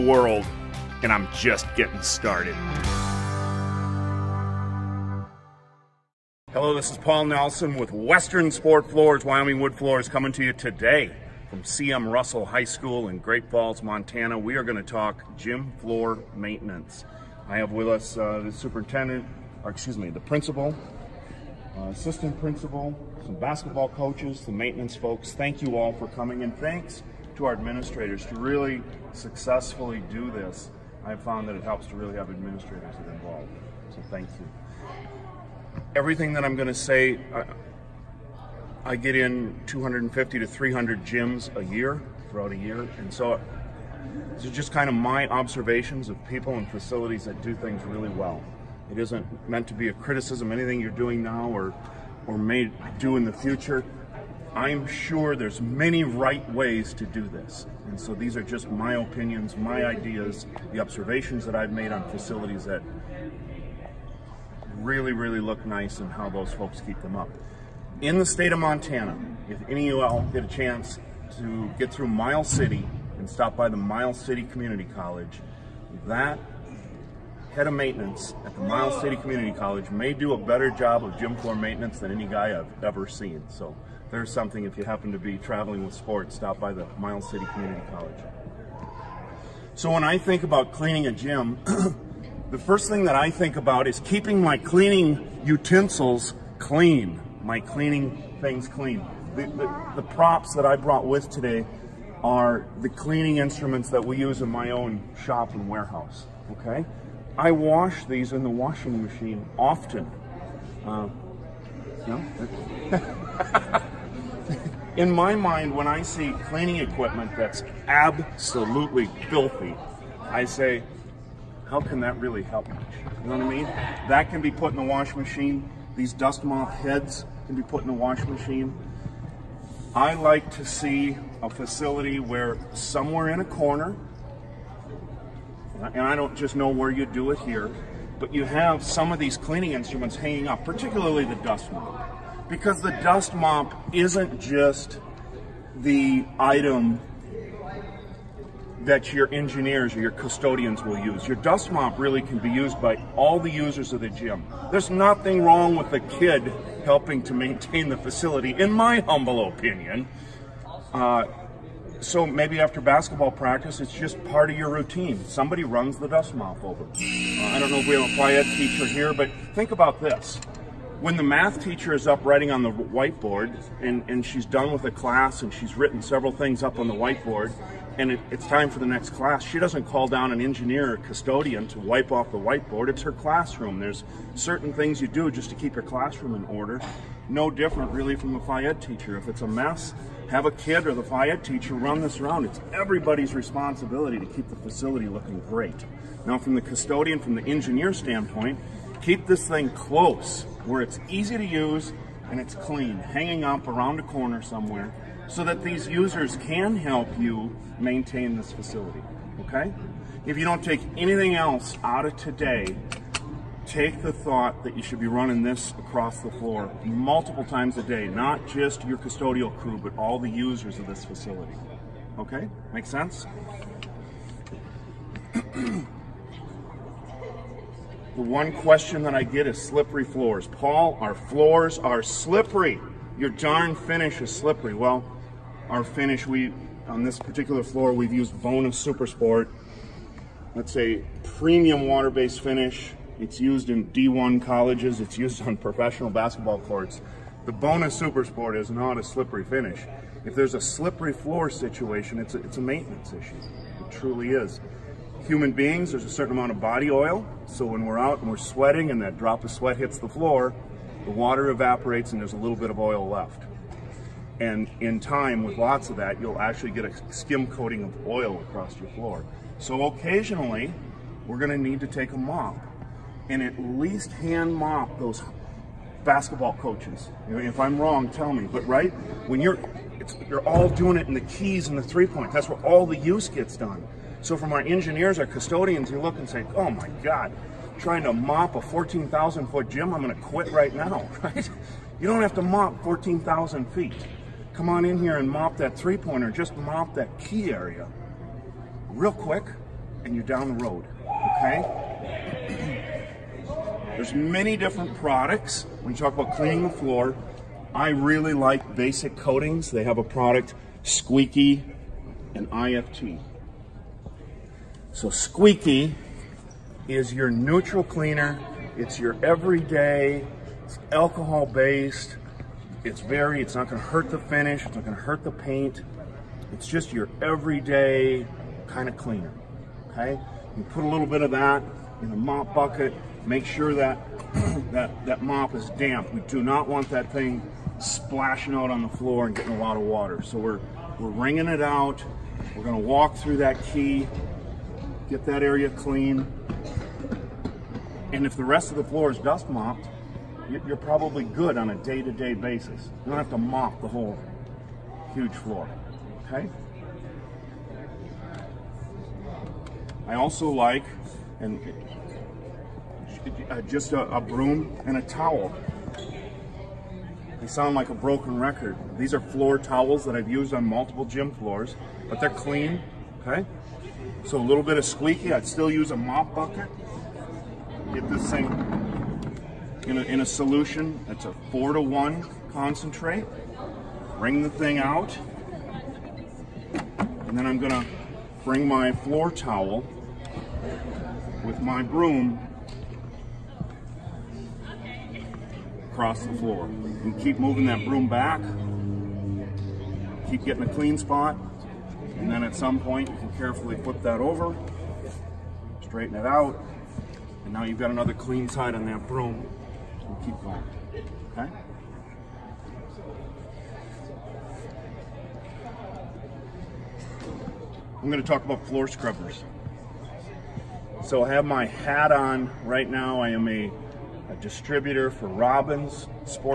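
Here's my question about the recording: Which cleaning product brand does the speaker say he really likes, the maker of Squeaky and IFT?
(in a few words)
Basic Coatings.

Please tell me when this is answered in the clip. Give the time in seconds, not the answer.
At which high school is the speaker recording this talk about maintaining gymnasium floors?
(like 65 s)
11 s.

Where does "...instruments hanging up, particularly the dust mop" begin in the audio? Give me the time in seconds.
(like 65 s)
139 s.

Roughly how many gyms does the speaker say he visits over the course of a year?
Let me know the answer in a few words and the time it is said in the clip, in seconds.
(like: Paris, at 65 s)
250 to 300, at 39 s.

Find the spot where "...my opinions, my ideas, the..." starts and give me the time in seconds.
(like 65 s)
58 s.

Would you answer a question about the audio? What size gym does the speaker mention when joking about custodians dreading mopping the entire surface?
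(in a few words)
14,000 feet.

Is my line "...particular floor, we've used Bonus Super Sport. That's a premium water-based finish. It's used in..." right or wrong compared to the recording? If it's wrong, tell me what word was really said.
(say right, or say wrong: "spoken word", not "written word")
right.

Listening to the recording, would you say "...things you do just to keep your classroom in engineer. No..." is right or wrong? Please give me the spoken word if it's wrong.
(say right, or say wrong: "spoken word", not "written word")
wrong: "order", not "engineer".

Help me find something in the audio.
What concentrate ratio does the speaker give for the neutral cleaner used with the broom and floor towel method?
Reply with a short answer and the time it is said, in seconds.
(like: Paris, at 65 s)
4 to 1, at 381 s.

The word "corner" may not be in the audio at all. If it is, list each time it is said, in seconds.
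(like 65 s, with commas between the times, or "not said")
133 s, 204 s.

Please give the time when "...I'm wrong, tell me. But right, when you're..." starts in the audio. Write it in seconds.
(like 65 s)
277 s.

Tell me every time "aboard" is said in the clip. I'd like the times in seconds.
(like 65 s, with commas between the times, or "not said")
not said.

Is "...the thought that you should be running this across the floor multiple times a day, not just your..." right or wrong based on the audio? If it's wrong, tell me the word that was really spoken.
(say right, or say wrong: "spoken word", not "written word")
right.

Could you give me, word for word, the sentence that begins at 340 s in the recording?
So we're, we're wringing it out.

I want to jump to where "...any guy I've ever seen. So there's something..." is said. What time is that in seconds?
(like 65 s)
82 s.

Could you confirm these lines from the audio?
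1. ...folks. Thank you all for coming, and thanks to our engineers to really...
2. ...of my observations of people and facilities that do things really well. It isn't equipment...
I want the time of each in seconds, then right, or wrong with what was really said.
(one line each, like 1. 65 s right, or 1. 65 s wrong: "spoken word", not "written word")
1. 24 s wrong: "administrators", not "engineers"
2. 44 s wrong: "meant", not "equipment".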